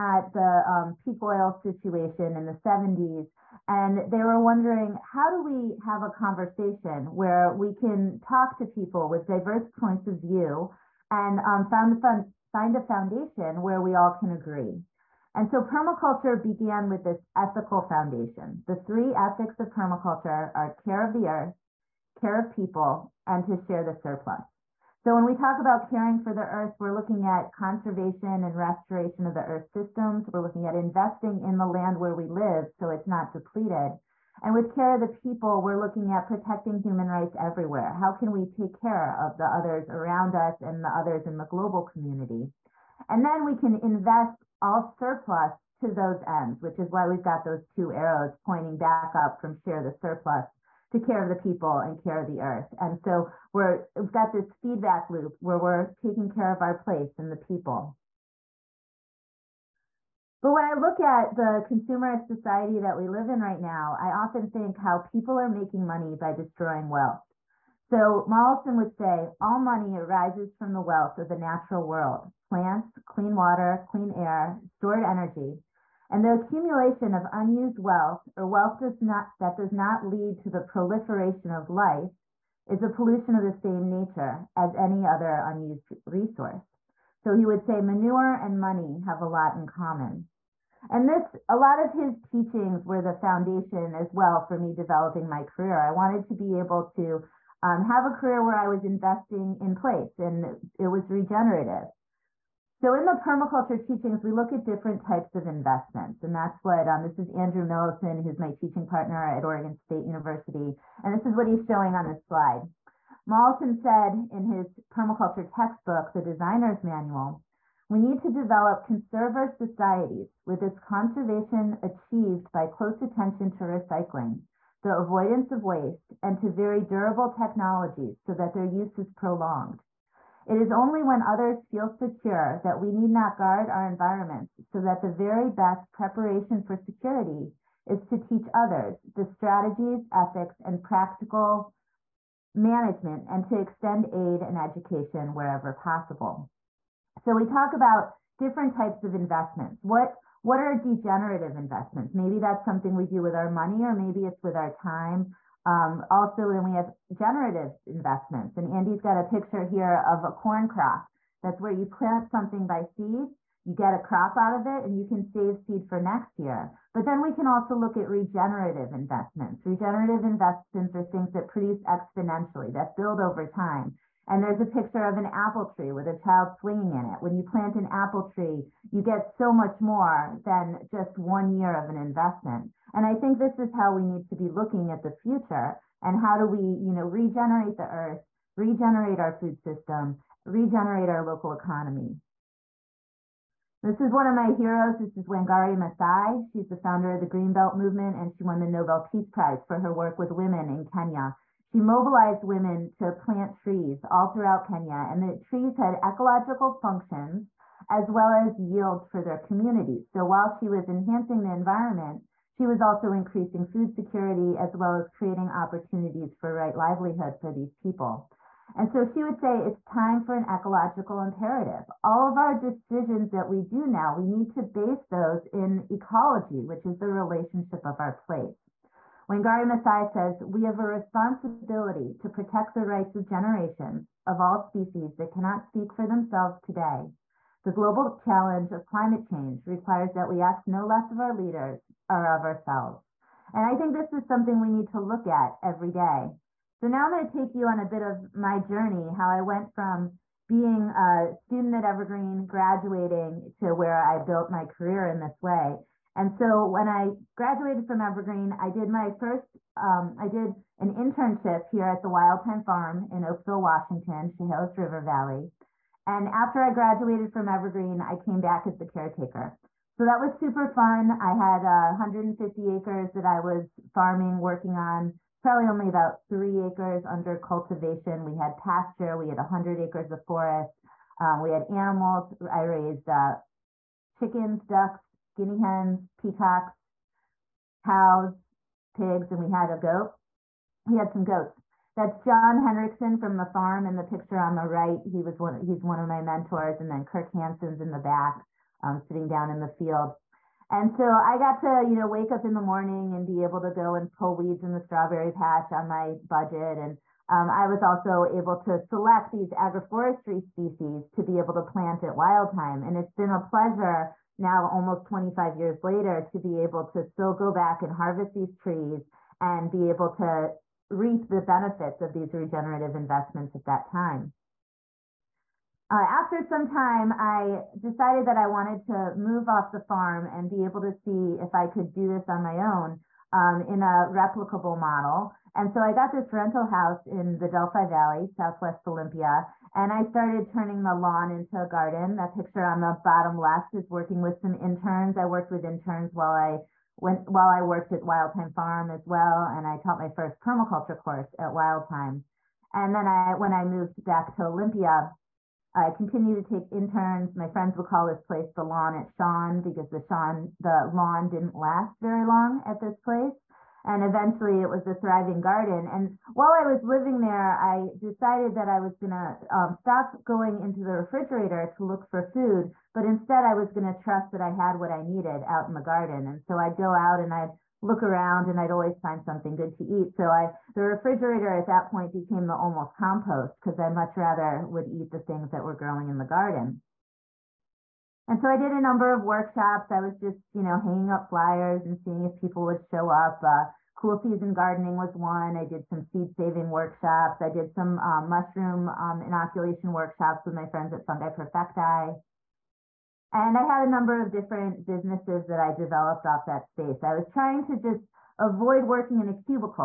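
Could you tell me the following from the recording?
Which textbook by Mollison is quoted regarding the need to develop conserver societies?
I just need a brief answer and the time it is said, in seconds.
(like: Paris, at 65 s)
The Designer's Manual, at 116 s.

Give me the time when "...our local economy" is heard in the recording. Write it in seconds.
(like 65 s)
191 s.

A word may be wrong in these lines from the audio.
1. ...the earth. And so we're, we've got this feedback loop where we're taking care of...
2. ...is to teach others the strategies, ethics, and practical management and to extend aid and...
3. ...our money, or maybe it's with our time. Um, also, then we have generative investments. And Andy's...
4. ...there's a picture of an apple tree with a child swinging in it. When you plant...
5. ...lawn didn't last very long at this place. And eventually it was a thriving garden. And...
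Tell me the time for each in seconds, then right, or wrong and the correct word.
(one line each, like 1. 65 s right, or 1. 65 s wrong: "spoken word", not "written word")
1. 52 s right
2. 137 s right
3. 153 s right
4. 174 s right
5. 360 s right.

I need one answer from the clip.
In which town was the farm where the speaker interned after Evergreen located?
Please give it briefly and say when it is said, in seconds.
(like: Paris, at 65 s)
Oakville, Washington, at 263 s.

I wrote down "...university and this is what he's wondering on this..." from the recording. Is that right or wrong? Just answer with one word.
wrong.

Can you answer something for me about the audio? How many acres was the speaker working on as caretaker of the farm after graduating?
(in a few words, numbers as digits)
150.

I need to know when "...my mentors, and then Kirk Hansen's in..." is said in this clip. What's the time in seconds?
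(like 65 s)
296 s.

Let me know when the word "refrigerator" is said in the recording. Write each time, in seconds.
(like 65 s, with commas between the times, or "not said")
370 s, 380 s.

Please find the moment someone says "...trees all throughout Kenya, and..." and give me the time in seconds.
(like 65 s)
203 s.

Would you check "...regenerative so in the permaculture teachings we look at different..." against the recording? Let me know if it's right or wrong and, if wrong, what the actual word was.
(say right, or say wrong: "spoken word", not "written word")
right.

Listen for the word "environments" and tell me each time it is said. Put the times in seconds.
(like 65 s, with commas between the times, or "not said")
133 s, 211 s.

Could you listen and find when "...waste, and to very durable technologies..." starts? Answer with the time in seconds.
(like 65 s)
125 s.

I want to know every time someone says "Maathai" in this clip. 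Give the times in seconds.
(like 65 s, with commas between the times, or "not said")
195 s, 229 s.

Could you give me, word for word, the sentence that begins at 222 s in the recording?
All of our decisions that we do now, we need to base those in ecology, which is the relationship of our place.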